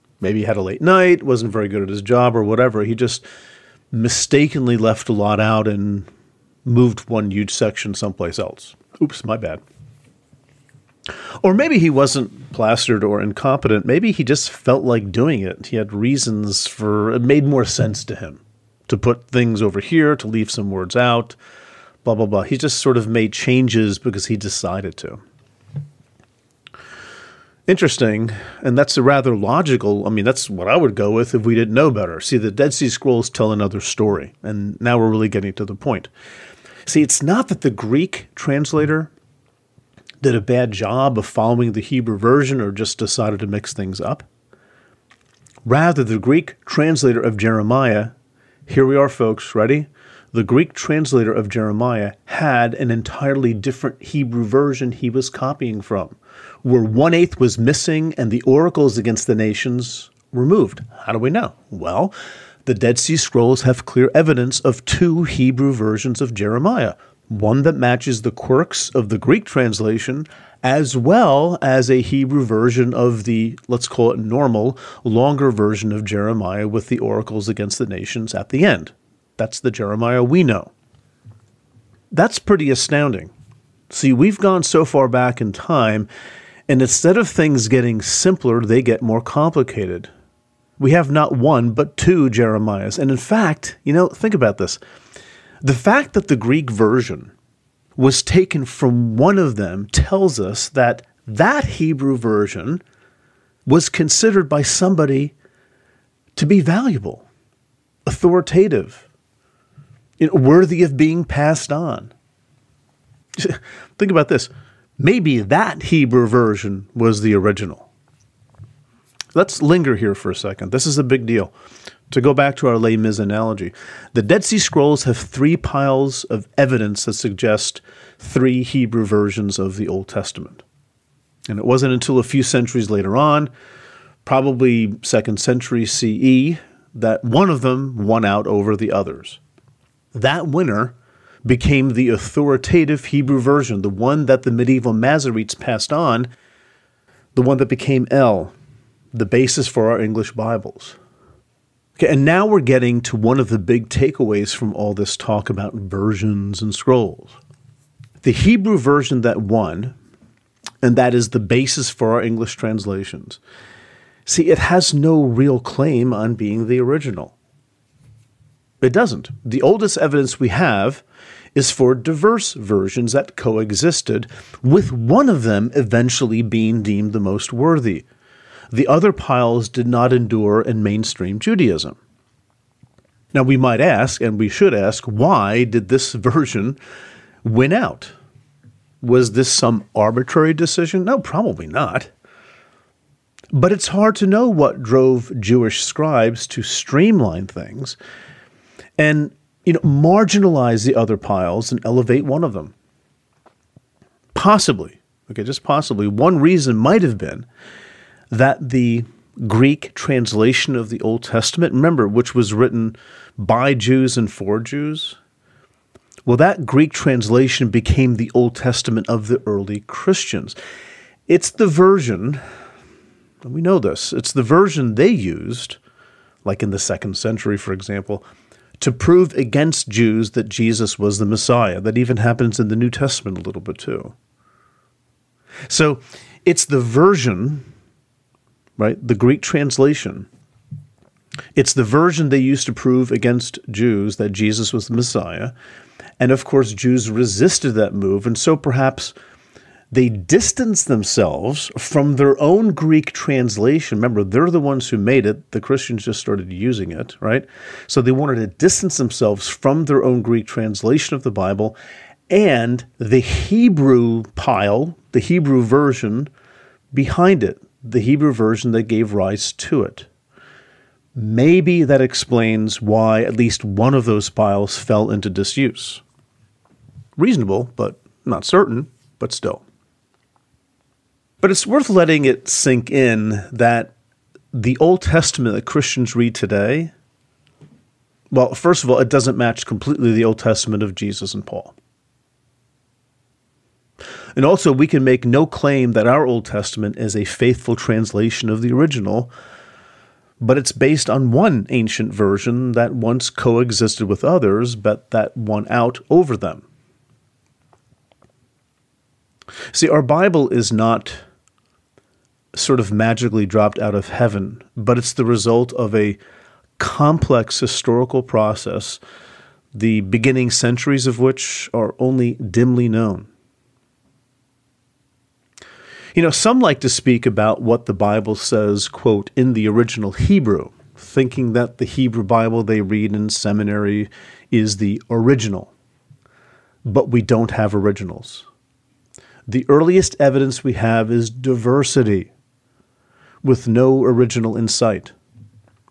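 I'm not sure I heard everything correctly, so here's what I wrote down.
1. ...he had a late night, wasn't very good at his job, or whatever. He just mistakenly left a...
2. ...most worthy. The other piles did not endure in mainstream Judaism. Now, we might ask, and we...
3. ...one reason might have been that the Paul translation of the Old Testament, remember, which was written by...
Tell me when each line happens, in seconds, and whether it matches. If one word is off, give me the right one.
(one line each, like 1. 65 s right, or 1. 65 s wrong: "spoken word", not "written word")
1. 0 s right
2. 177 s right
3. 206 s wrong: "Greek", not "Paul".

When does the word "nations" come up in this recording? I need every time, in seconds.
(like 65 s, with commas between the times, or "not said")
59 s, 77 s.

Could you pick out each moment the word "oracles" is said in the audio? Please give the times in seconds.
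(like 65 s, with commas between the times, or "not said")
58 s, 76 s.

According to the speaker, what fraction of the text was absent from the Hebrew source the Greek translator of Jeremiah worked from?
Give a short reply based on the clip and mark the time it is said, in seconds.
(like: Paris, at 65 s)
one eighth, at 56 s.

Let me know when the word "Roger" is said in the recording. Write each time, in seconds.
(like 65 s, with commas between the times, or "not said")
not said.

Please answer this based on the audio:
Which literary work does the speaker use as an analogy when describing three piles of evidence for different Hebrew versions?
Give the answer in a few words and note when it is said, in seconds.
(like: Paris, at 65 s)
Les Mis, at 122 s.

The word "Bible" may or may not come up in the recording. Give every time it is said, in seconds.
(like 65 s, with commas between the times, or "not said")
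150 s, 261 s, 310 s, 327 s, 332 s.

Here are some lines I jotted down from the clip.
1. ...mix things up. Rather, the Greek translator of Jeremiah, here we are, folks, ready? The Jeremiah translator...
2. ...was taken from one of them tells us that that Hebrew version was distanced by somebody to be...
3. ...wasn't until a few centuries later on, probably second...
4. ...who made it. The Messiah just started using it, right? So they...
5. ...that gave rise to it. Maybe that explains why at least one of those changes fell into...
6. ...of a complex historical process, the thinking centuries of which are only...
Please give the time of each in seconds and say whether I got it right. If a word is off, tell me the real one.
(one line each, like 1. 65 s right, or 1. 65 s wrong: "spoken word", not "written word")
1. 43 s wrong: "Greek", not "Jeremiah"
2. 97 s wrong: "considered", not "distanced"
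3. 131 s right
4. 254 s wrong: "Christians", not "Messiah"
5. 268 s wrong: "files", not "changes"
6. 315 s wrong: "beginning", not "thinking".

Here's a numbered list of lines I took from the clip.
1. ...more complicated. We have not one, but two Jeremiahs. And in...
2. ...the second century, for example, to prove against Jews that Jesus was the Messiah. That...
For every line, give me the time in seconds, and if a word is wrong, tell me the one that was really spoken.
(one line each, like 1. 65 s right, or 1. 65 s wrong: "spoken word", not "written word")
1. 89 s right
2. 226 s right.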